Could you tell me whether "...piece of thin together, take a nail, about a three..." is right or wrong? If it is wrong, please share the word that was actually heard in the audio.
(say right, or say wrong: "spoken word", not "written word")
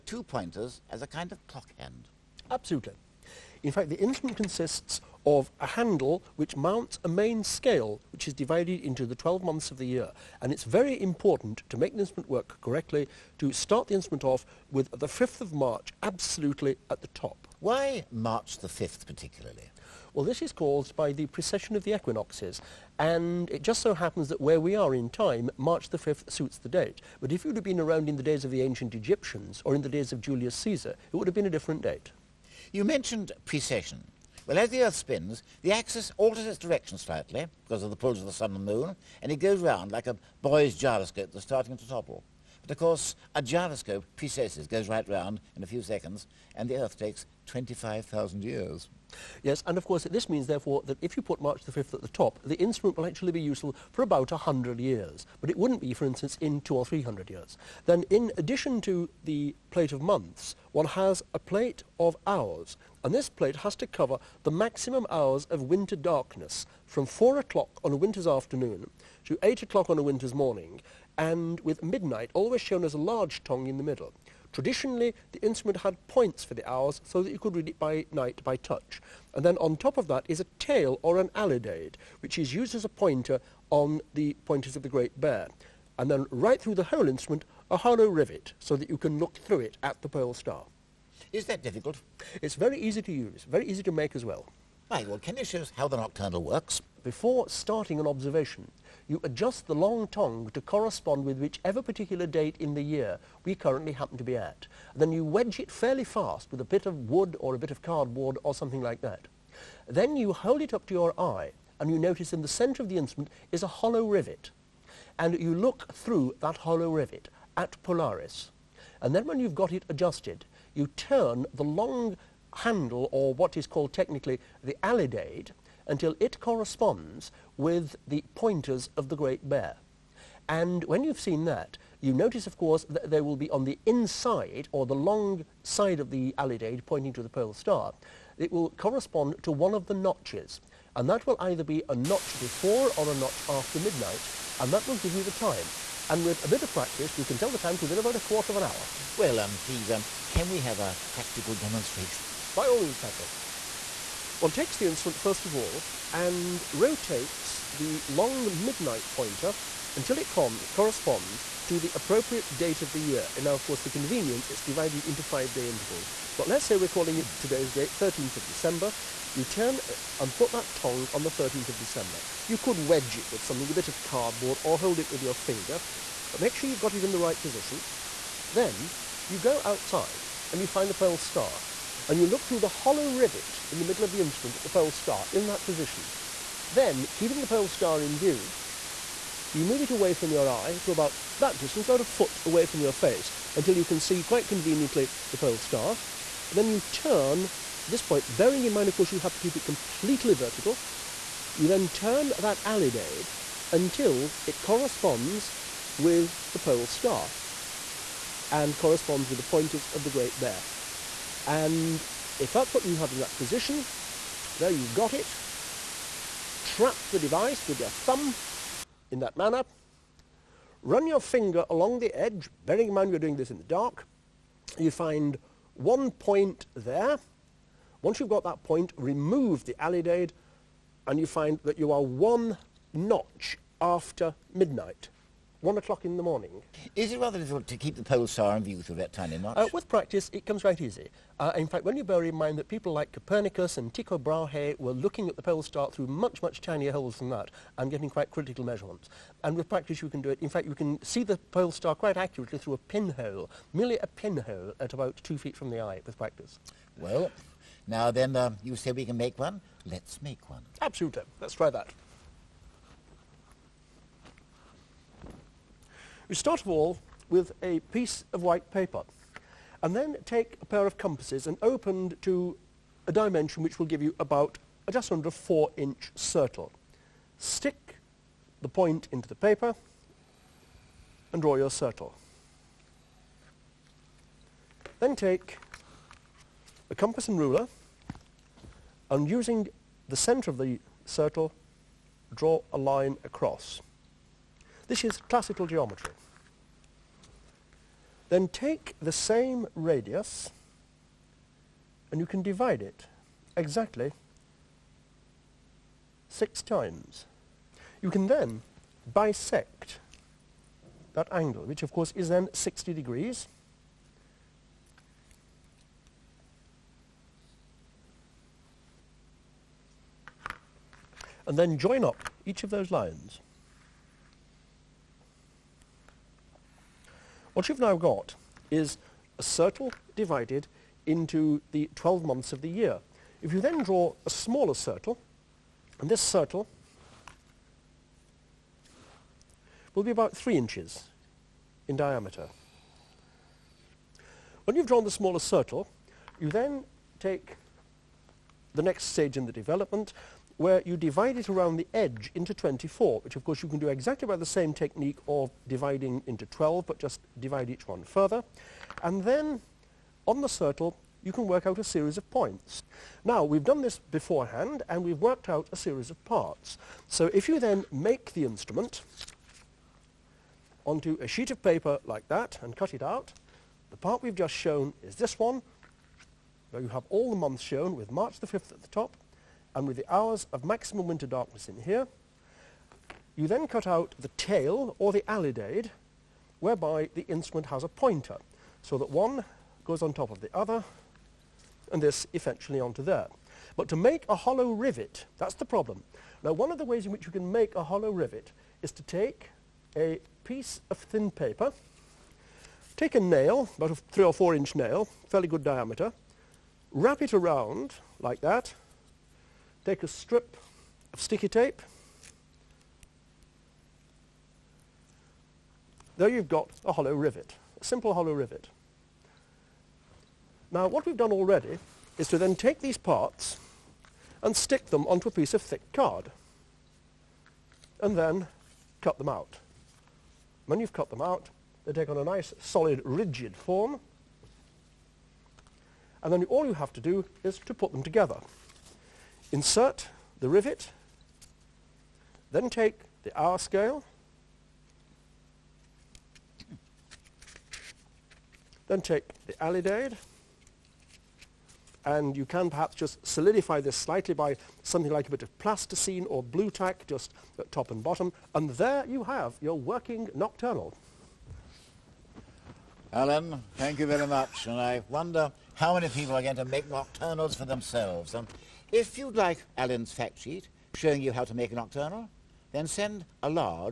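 wrong: "paper", not "together".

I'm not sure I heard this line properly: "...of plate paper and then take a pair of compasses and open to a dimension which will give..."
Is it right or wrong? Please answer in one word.
wrong.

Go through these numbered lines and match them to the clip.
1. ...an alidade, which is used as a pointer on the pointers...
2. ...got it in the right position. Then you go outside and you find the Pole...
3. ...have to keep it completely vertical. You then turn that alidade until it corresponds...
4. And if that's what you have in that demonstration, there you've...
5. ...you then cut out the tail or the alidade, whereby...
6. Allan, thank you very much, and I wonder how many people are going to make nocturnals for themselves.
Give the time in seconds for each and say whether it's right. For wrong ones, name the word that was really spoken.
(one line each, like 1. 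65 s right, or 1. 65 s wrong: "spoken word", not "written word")
1. 81 s right
2. 176 s right
3. 199 s right
4. 211 s wrong: "position", not "demonstration"
5. 383 s right
6. 463 s right.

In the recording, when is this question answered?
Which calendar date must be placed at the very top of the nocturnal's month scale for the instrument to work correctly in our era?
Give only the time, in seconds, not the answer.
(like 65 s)
15 s.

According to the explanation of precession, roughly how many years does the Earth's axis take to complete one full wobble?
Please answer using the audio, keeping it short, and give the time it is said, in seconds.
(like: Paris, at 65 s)
25,000, at 47 s.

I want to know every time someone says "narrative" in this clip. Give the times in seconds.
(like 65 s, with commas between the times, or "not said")
not said.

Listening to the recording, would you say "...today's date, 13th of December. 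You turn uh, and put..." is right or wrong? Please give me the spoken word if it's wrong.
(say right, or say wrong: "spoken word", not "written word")
right.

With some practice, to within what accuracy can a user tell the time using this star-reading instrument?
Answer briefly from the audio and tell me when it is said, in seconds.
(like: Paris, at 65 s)
A quarter of an hour, at 148 s.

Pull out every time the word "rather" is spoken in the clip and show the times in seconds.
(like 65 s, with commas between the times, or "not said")
237 s.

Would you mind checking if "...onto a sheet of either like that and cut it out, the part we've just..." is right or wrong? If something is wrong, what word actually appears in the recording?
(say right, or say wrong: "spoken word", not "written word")
wrong: "paper", not "either".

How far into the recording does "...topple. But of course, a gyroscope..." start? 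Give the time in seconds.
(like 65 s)
41 s.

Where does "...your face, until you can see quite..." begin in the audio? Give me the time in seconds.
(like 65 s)
192 s.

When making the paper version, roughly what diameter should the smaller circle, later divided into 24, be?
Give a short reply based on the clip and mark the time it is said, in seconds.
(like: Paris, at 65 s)
3 inches, at 340 s.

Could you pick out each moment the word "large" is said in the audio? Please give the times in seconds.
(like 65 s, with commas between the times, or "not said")
72 s.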